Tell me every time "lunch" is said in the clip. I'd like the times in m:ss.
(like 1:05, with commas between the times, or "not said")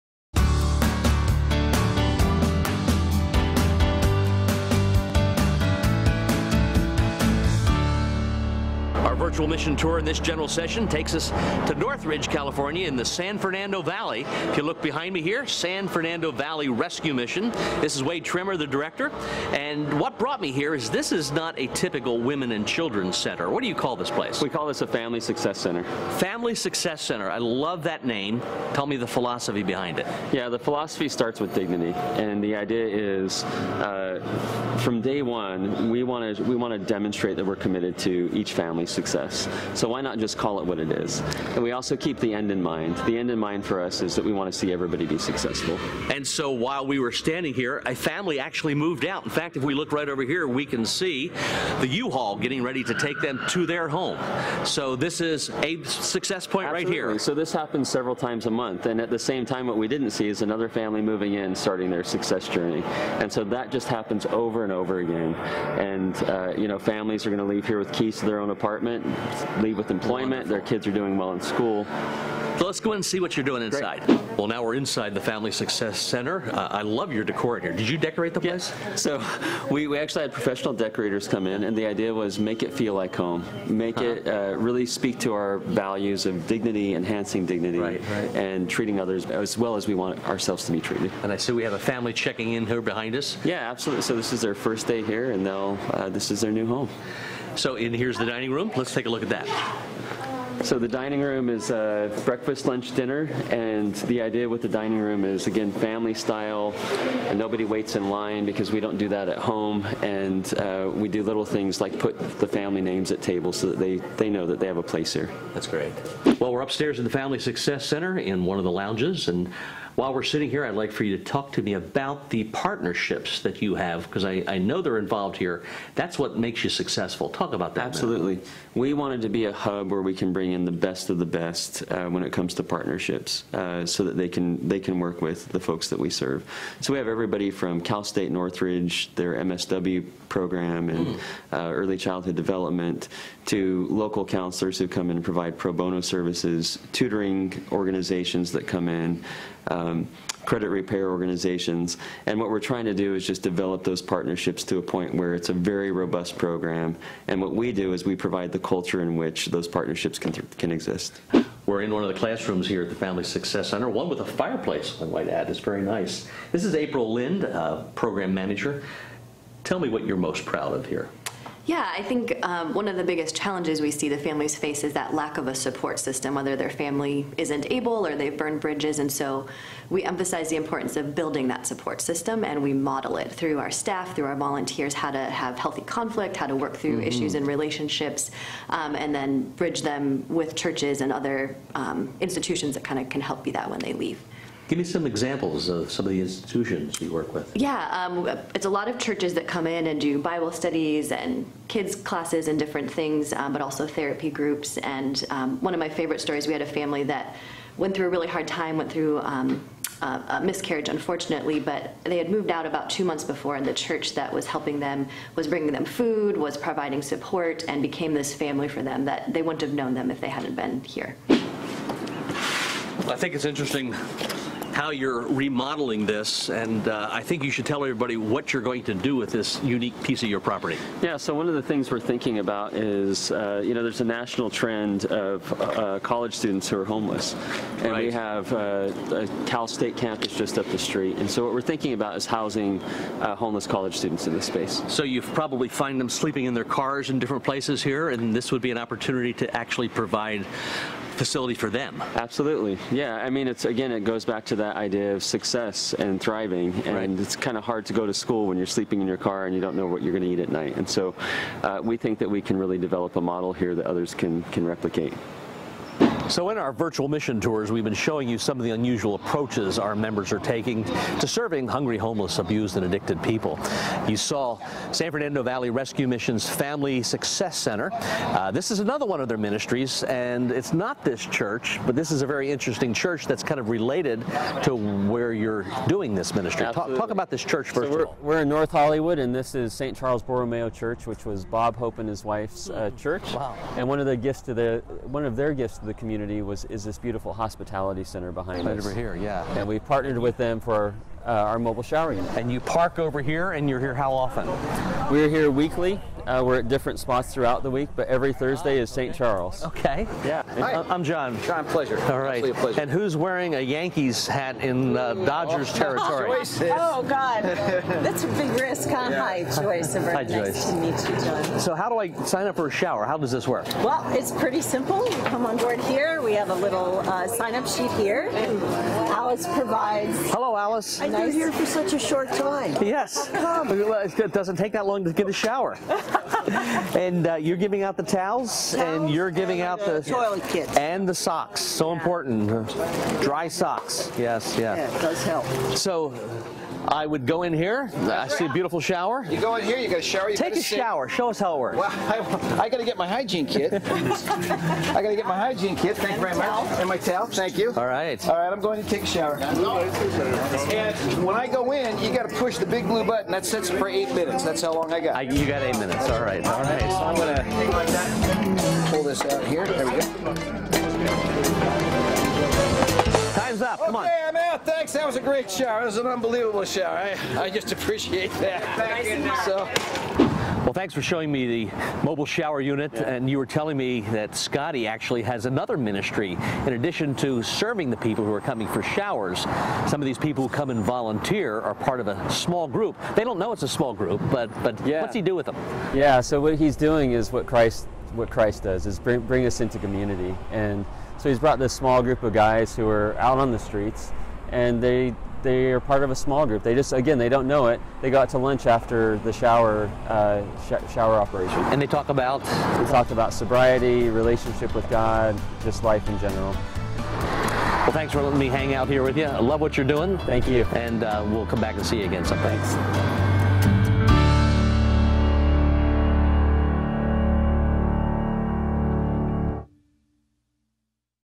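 1:42, 6:48.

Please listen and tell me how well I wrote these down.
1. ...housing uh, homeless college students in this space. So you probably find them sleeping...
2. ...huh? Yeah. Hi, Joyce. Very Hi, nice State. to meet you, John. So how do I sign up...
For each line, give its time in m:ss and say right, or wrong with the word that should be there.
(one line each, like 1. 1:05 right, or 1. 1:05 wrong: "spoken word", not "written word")
1. 4:02 right
2. 5:18 wrong: "Joyce", not "State".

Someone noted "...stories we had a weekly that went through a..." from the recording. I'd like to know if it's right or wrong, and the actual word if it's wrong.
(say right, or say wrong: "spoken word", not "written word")
wrong: "family", not "weekly".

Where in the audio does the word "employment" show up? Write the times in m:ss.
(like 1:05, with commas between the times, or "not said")
1:09.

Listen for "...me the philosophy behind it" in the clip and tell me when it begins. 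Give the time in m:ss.
0:28.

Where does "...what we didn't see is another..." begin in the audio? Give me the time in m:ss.
0:59.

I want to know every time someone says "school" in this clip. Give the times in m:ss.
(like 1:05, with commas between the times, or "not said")
1:11, 4:18.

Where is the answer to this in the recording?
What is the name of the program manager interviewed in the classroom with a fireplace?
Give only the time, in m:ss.
2:46.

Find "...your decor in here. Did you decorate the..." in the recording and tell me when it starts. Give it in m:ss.
1:17.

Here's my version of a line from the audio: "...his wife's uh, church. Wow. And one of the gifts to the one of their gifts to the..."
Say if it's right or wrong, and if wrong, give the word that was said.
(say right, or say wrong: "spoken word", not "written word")
right.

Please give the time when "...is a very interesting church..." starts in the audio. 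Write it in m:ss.
4:42.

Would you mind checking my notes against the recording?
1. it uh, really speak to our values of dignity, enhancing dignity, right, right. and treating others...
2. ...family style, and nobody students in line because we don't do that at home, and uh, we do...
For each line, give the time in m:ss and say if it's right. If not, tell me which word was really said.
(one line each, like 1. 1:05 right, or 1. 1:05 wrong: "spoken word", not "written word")
1. 1:24 right
2. 1:45 wrong: "waits", not "students".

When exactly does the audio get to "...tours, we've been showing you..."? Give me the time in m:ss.
4:27.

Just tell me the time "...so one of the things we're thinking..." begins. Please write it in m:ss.
3:51.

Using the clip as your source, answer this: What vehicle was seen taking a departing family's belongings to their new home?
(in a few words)
U-Haul.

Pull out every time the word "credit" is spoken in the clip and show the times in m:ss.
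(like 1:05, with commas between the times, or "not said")
2:30.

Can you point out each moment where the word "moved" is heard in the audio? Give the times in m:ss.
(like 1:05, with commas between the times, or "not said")
0:48, 3:32.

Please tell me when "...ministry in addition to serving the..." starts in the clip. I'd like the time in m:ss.
6:25.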